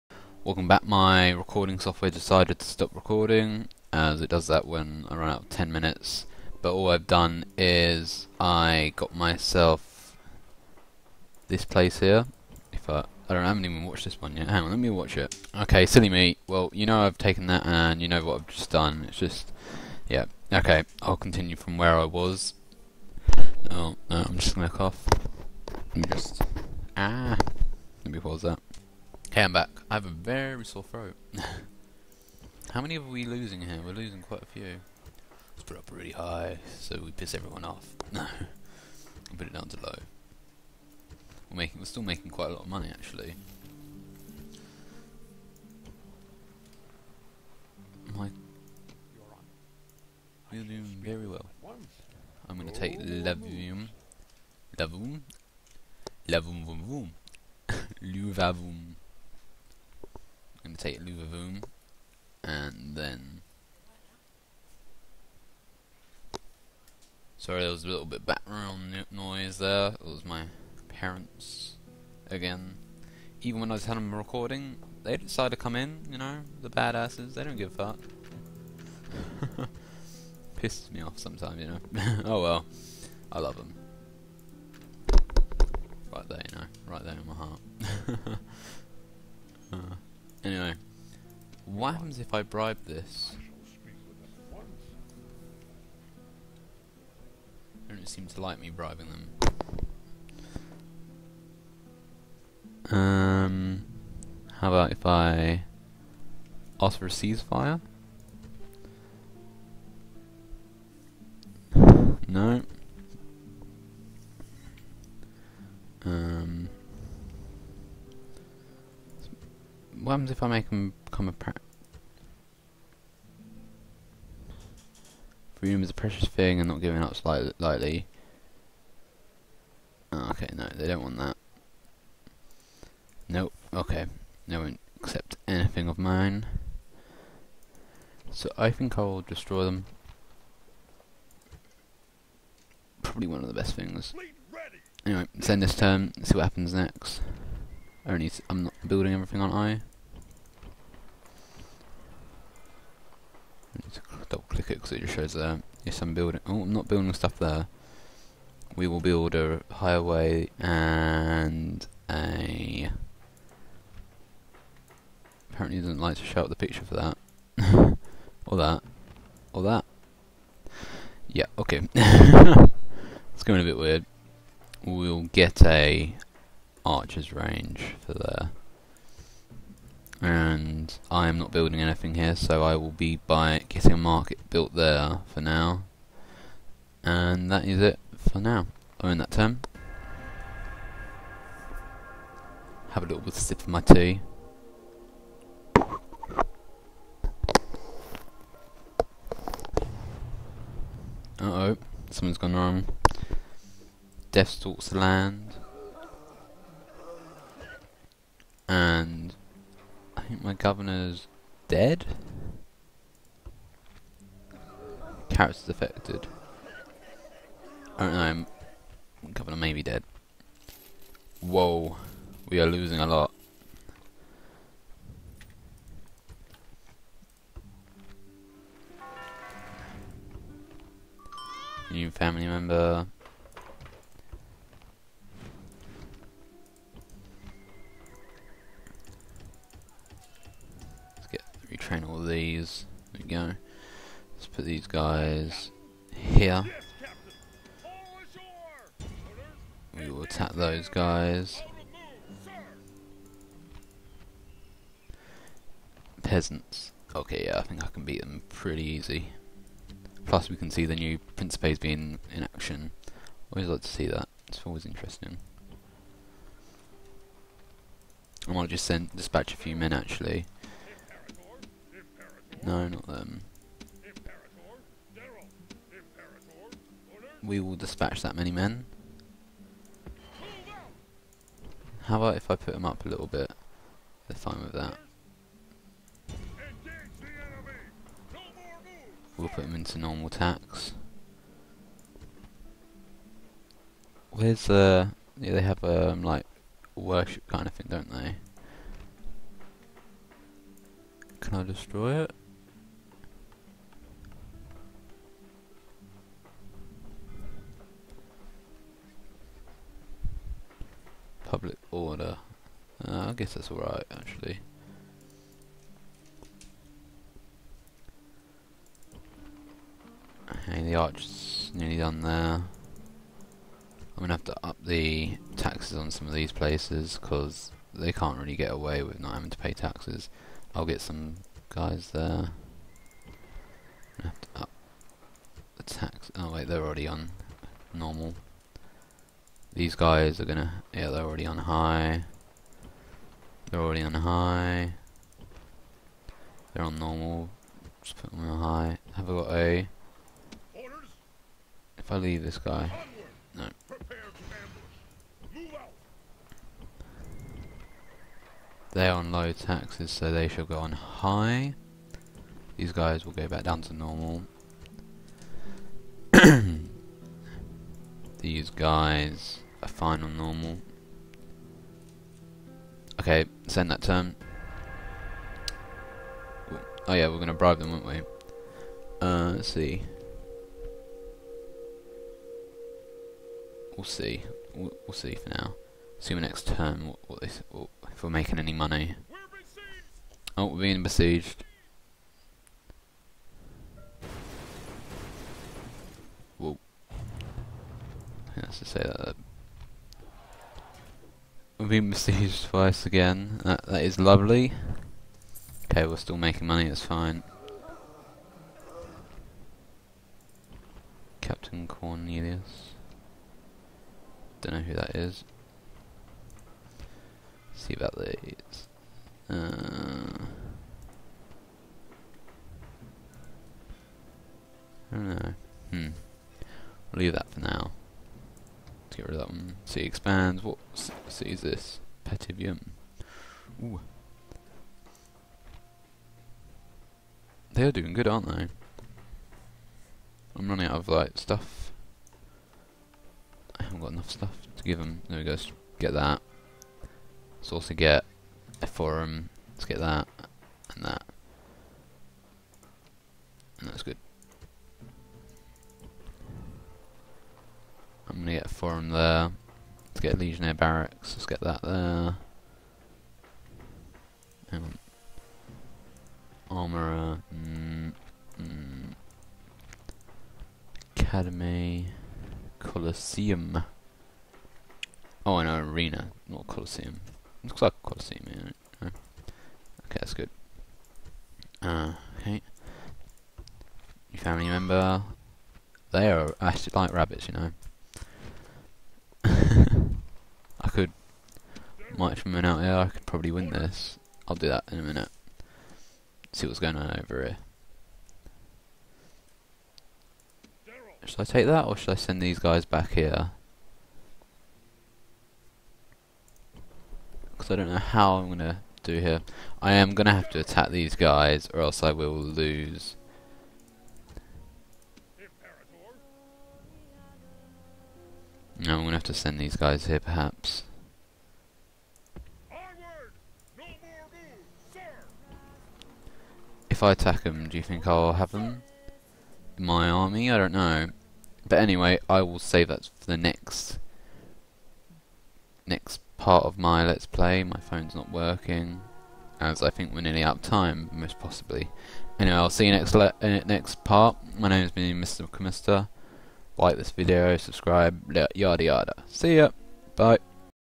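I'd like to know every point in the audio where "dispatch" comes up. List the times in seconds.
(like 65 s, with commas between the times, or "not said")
269 s, 277 s.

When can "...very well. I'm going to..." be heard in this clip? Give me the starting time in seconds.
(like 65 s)
51 s.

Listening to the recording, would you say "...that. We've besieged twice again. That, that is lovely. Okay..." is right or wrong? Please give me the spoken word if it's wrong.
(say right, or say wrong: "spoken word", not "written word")
right.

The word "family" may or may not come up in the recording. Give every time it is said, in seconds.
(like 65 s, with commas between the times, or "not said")
232 s, 484 s.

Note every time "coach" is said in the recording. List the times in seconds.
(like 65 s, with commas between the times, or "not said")
not said.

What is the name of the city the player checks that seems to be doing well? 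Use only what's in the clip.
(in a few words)
Petivium.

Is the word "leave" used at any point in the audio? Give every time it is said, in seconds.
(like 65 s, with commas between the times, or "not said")
352 s, 427 s.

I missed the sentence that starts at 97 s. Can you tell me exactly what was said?
They don't seem to like me bribing them.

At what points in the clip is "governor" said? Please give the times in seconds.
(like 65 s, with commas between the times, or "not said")
210 s, 219 s.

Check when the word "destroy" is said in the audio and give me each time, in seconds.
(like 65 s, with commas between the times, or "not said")
139 s, 301 s.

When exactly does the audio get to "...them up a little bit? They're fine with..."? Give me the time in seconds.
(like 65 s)
282 s.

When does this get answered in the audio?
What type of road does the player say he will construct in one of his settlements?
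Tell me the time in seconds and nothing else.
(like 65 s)
159 s.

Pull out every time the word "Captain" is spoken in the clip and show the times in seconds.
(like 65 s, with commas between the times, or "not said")
411 s.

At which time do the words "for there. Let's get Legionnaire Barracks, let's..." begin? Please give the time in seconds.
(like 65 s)
458 s.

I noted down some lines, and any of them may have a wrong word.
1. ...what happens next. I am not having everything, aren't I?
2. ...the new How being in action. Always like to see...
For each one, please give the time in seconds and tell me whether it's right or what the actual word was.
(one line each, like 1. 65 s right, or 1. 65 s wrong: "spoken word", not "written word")
1. 146 s wrong: "building", not "having"
2. 260 s wrong: "Principes", not "How".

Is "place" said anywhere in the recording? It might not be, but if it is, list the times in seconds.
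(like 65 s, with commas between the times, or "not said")
11 s, 326 s.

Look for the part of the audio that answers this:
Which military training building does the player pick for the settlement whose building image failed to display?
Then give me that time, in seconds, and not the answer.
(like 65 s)
176 s.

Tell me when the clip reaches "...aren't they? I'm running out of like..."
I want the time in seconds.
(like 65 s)
438 s.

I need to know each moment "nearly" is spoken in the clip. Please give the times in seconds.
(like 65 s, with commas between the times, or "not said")
321 s, 540 s.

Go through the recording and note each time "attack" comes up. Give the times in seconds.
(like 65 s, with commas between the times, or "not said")
250 s, 510 s, 527 s.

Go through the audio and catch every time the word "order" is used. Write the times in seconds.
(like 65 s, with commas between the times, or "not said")
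311 s.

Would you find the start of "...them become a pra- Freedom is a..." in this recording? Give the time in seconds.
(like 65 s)
120 s.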